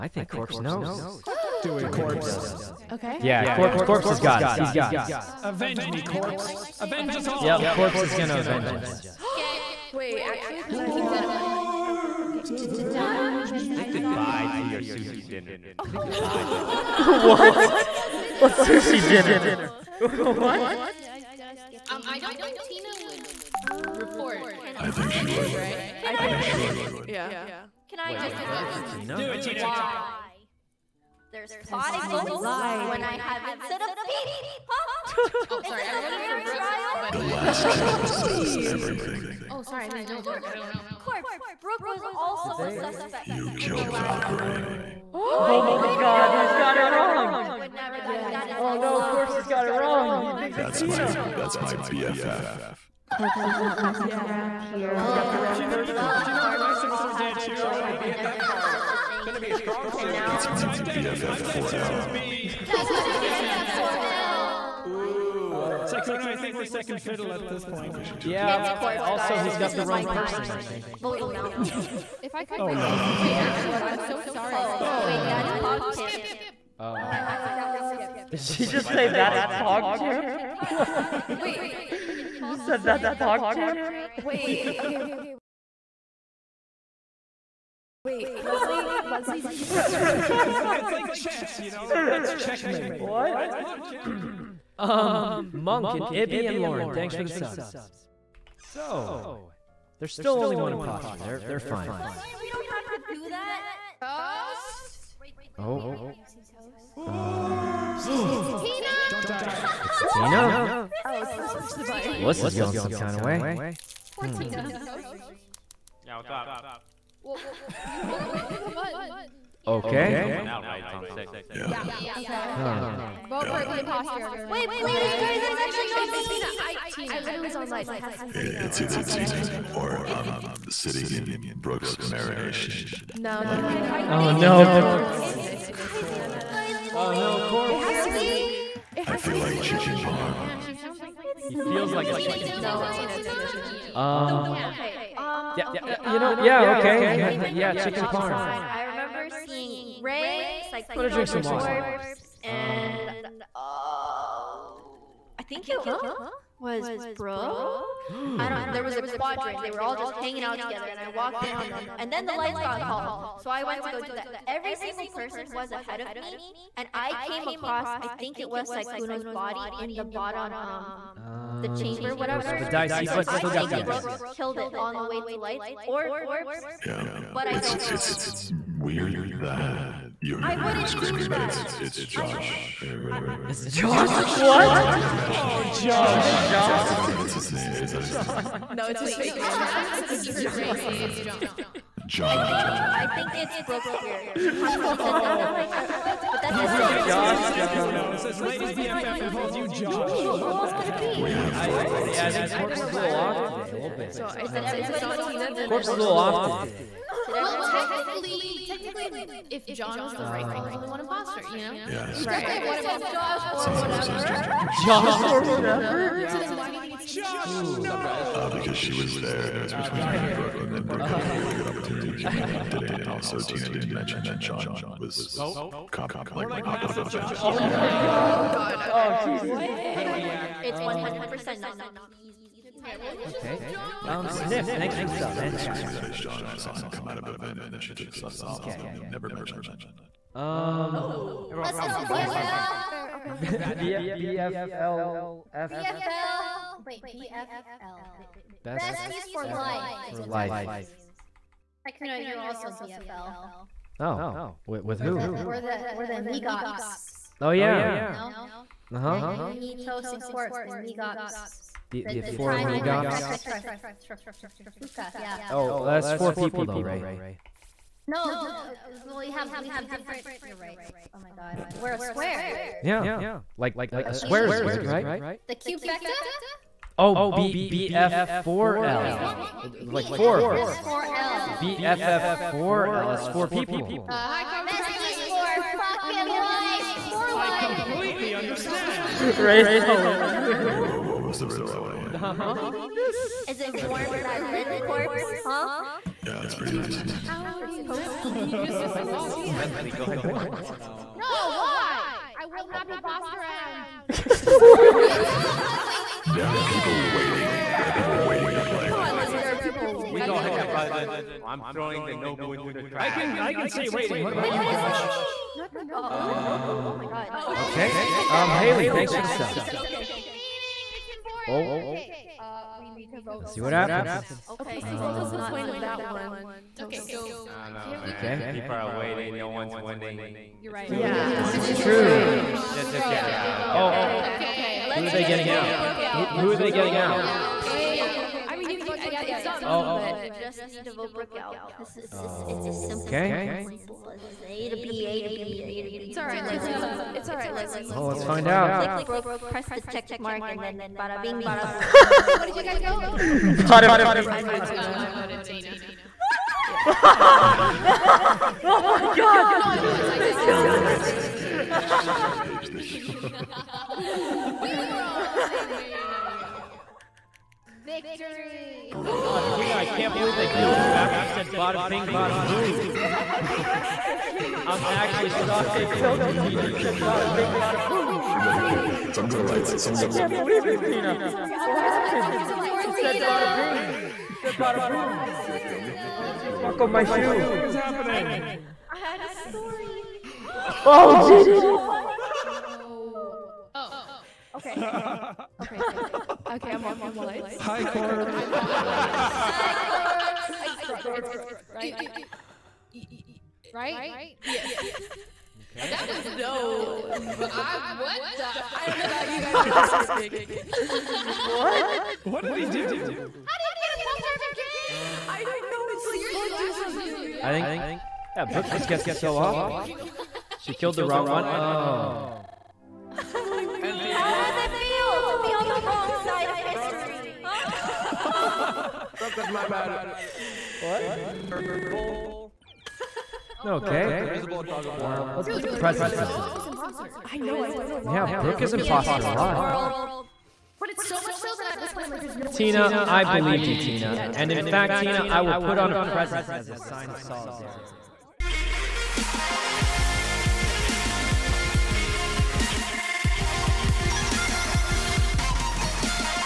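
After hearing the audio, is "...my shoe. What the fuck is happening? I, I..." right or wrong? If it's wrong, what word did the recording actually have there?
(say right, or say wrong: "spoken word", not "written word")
right.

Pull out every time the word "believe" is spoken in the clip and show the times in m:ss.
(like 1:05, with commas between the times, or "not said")
6:10, 6:20, 7:23.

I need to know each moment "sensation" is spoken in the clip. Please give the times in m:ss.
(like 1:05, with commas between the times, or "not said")
not said.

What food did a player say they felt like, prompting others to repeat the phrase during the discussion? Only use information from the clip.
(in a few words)
chicken parm.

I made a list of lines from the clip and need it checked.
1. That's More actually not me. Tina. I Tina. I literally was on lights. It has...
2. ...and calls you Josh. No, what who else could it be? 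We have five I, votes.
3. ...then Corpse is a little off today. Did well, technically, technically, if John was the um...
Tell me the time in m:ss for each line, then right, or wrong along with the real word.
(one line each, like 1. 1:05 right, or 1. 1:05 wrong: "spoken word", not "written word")
1. 2:05 wrong: "Why", not "More"
2. 3:19 wrong: "four", not "five"
3. 3:25 right.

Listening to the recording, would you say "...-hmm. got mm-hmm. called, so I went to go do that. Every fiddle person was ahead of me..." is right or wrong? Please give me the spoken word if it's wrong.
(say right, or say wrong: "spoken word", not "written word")
wrong: "single", not "fiddle".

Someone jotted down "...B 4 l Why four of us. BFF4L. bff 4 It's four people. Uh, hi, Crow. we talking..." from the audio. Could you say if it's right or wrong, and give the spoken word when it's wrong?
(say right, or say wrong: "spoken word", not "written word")
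wrong: "Like", not "Why".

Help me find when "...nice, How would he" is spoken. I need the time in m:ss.
4:56.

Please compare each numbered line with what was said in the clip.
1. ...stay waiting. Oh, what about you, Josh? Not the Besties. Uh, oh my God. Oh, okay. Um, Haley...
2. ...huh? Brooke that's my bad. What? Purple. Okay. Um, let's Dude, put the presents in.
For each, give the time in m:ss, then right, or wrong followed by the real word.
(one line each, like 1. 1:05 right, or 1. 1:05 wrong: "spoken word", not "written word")
1. 5:13 wrong: "Nobu", not "Besties"
2. 7:07 right.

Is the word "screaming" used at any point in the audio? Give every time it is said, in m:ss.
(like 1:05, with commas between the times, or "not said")
3:00, 3:55.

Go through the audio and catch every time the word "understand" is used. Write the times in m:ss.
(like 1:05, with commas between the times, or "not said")
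4:48, 4:58.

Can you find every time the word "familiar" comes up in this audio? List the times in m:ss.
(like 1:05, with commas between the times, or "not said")
not said.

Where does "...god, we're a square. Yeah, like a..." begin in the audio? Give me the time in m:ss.
4:31.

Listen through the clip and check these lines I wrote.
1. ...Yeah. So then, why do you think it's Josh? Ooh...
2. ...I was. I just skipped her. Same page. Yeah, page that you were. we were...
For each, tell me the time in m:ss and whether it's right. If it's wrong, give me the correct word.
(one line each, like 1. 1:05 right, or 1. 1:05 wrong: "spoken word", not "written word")
1. 3:36 right
2. 5:59 wrong: "killed", not "skipped".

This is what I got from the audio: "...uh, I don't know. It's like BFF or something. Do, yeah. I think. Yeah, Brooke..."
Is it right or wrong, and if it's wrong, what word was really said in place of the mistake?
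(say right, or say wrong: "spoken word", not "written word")
wrong: "Brooke", not "BFF".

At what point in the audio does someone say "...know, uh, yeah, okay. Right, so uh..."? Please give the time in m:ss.
2:26.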